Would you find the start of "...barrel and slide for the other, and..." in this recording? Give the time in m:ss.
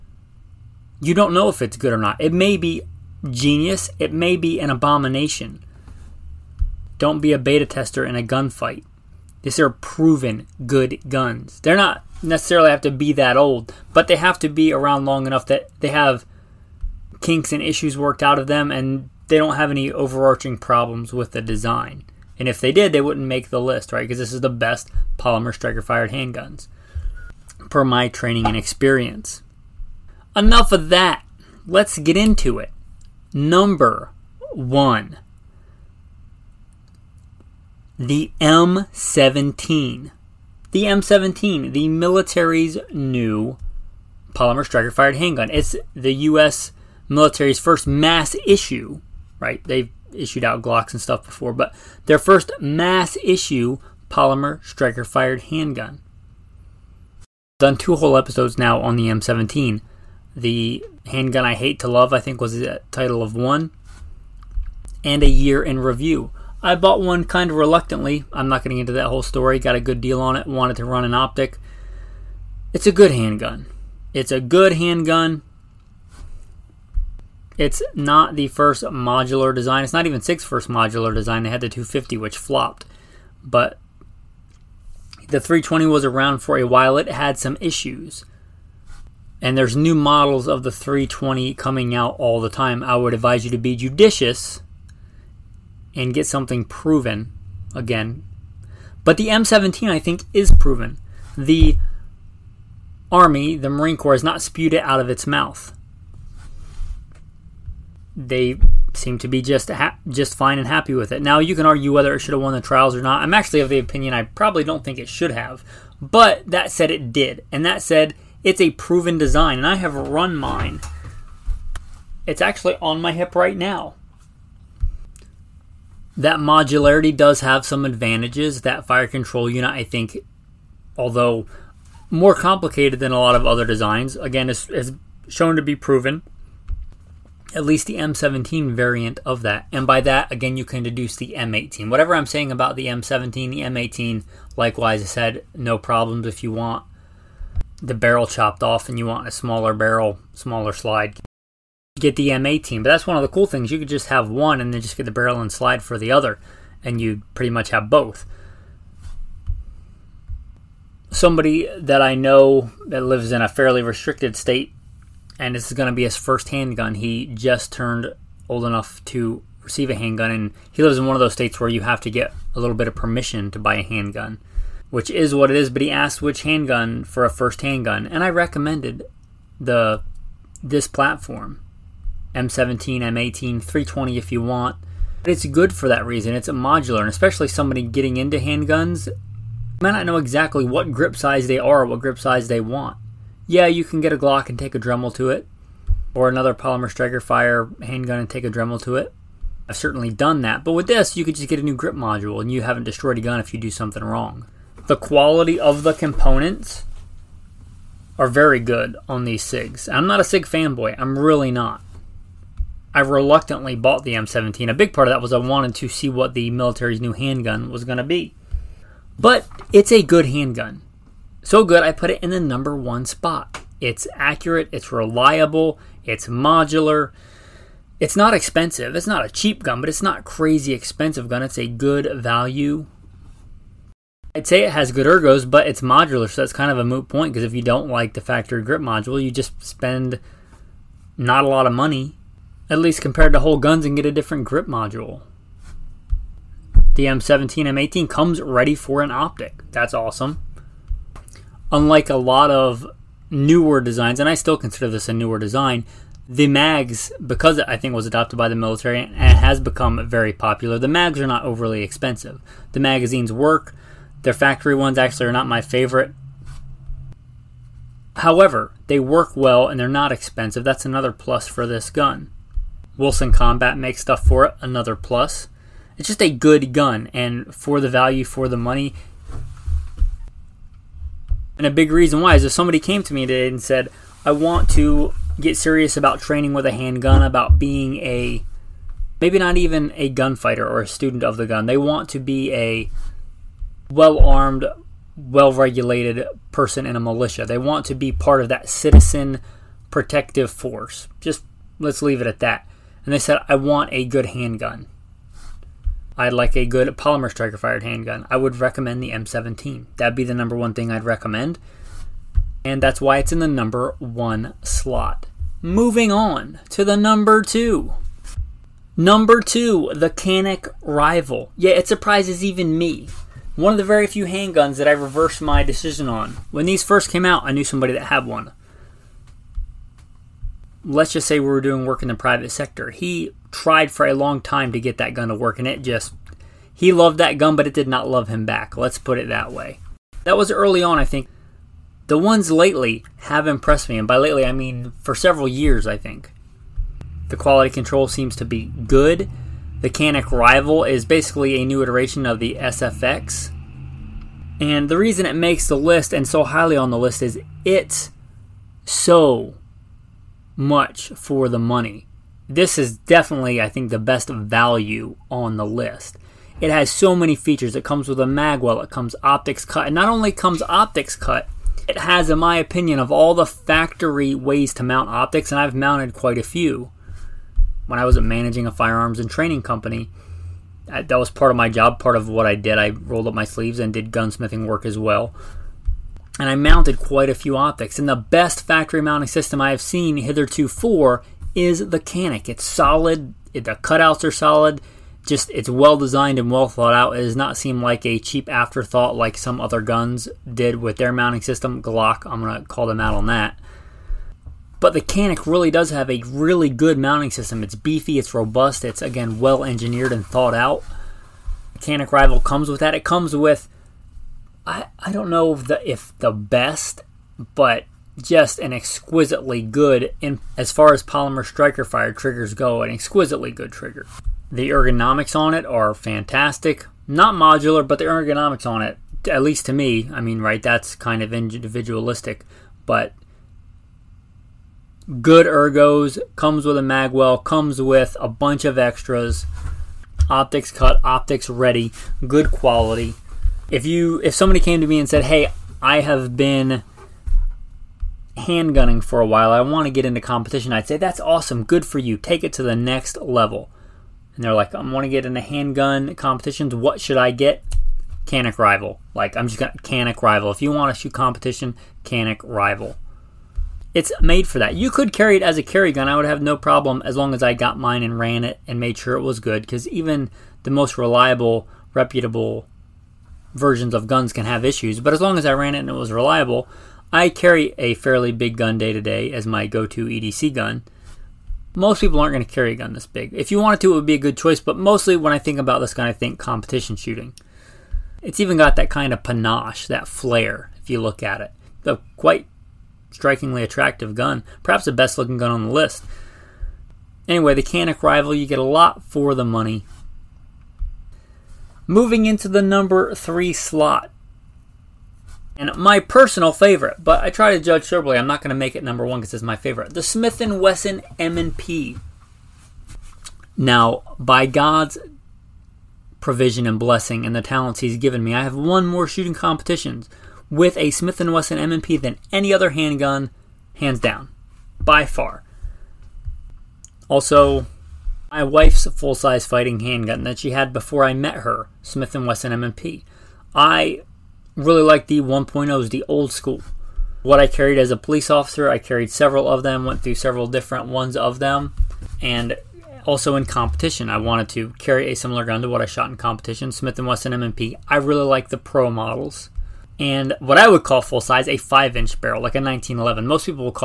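2:35.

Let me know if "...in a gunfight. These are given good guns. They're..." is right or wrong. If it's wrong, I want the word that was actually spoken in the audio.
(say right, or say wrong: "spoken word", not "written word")
wrong: "proven", not "given".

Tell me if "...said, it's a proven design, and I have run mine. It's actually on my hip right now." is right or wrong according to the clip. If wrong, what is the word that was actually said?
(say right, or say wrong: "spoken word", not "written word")
right.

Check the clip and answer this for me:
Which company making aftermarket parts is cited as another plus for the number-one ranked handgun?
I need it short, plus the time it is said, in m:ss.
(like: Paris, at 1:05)
Wilson Combat, at 4:32.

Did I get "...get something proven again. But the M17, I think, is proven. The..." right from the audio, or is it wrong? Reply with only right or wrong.
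right.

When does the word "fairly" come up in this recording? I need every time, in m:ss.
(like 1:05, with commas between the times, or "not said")
2:43, 7:57.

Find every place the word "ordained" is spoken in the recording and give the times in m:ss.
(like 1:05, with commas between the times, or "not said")
not said.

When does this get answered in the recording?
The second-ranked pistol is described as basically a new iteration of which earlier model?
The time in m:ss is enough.
5:52.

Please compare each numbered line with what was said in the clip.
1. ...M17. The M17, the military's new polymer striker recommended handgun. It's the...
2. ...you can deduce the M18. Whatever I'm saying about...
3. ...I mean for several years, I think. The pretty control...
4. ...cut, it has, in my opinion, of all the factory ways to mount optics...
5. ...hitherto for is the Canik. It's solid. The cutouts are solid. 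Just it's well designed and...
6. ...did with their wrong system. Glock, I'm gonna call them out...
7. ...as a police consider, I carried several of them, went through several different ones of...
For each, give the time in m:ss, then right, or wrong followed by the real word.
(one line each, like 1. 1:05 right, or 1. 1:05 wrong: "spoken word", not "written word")
1. 0:38 wrong: "fired", not "recommended"
2. 2:20 right
3. 5:44 wrong: "quality", not "pretty"
4. 6:11 right
5. 6:30 right
6. 6:40 wrong: "mounting", not "wrong"
7. 8:57 wrong: "officer", not "consider".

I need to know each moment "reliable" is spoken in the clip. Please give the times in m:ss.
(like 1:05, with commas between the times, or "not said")
3:44, 7:50, 7:56.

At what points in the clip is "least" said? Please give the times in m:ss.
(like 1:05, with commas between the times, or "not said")
2:17, 4:02, 7:09.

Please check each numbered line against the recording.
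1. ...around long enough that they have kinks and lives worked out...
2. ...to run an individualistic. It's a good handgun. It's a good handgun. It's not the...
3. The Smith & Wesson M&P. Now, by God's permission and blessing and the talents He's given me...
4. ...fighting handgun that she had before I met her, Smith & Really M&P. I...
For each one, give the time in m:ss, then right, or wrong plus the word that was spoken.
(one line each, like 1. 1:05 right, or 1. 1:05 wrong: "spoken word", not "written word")
1. 0:14 wrong: "issues", not "lives"
2. 1:10 wrong: "optic", not "individualistic"
3. 8:29 wrong: "provision", not "permission"
4. 8:49 wrong: "Wesson", not "Really".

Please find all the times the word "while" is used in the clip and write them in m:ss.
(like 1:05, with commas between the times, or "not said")
1:26, 7:29.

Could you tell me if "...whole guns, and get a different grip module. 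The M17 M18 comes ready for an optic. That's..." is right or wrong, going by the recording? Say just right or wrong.
right.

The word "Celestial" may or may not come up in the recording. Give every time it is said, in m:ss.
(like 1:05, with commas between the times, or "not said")
not said.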